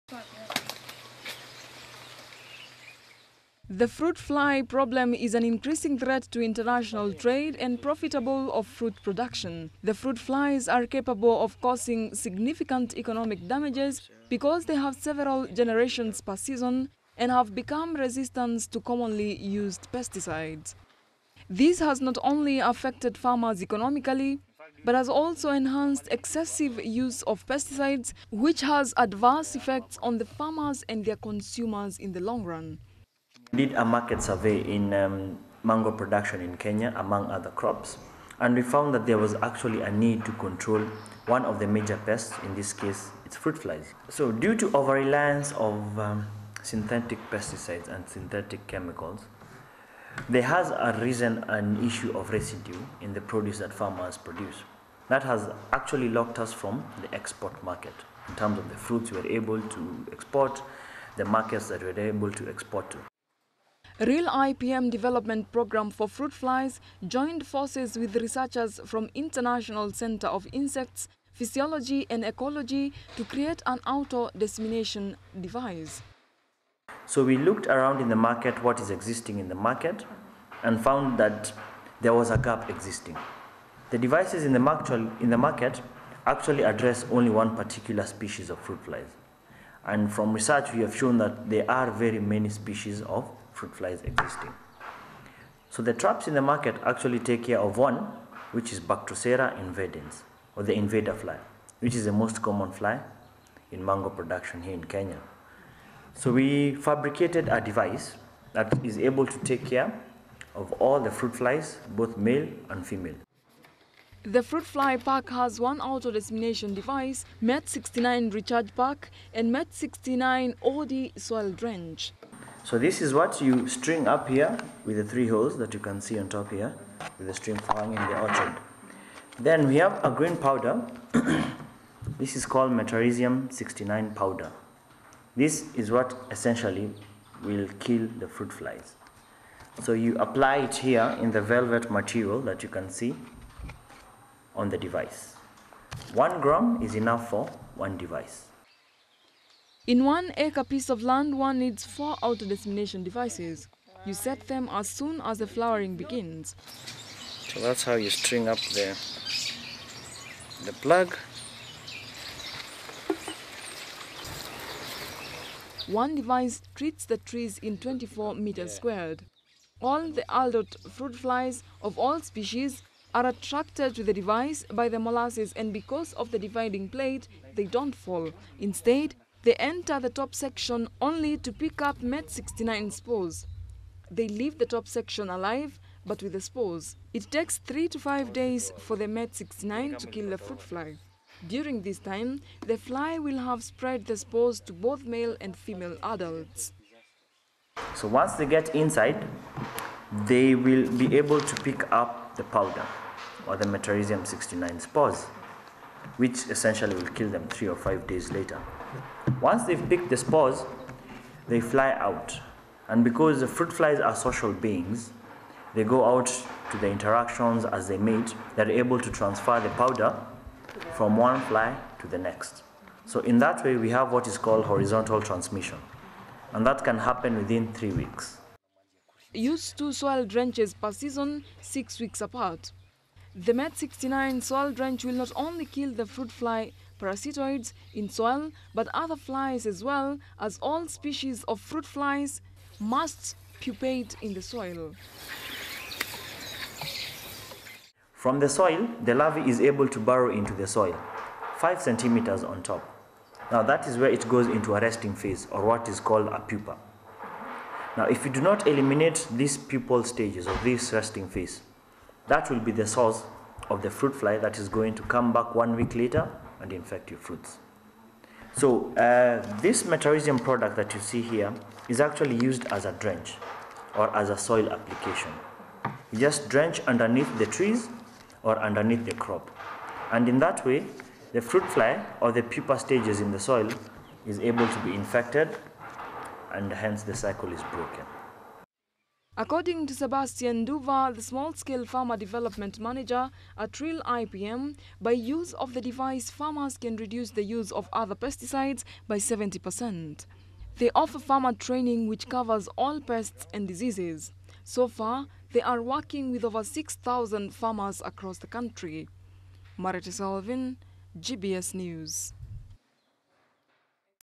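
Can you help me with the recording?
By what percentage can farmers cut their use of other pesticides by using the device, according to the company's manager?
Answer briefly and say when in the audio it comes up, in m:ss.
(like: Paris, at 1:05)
70%, at 4:59.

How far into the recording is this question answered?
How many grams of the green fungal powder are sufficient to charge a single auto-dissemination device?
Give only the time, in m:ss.
2:26.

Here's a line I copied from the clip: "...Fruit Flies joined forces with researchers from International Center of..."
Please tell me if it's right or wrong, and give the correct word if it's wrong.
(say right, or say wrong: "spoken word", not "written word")
right.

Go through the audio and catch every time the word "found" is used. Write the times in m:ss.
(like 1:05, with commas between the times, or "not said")
0:38, 1:20.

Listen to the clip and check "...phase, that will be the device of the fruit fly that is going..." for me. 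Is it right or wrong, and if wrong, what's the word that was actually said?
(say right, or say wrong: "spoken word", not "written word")
wrong: "source", not "device".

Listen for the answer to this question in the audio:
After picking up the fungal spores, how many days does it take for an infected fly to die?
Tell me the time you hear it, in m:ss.
3:07.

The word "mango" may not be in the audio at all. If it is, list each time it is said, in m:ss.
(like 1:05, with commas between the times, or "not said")
0:35, 1:43.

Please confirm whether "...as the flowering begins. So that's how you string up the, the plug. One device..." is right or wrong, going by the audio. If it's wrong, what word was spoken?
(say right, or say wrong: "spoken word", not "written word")
right.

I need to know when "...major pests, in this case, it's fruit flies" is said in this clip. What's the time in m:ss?
0:41.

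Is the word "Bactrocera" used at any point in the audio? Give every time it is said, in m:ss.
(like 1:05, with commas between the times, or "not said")
1:38.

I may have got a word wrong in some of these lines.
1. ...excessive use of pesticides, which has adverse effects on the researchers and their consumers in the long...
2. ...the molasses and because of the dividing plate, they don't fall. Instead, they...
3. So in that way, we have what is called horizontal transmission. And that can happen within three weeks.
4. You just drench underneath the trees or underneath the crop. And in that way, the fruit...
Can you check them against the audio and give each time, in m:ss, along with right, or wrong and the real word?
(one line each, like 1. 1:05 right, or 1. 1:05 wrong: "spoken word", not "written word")
1. 0:26 wrong: "farmers", not "researchers"
2. 2:54 right
3. 3:43 right
4. 4:36 right.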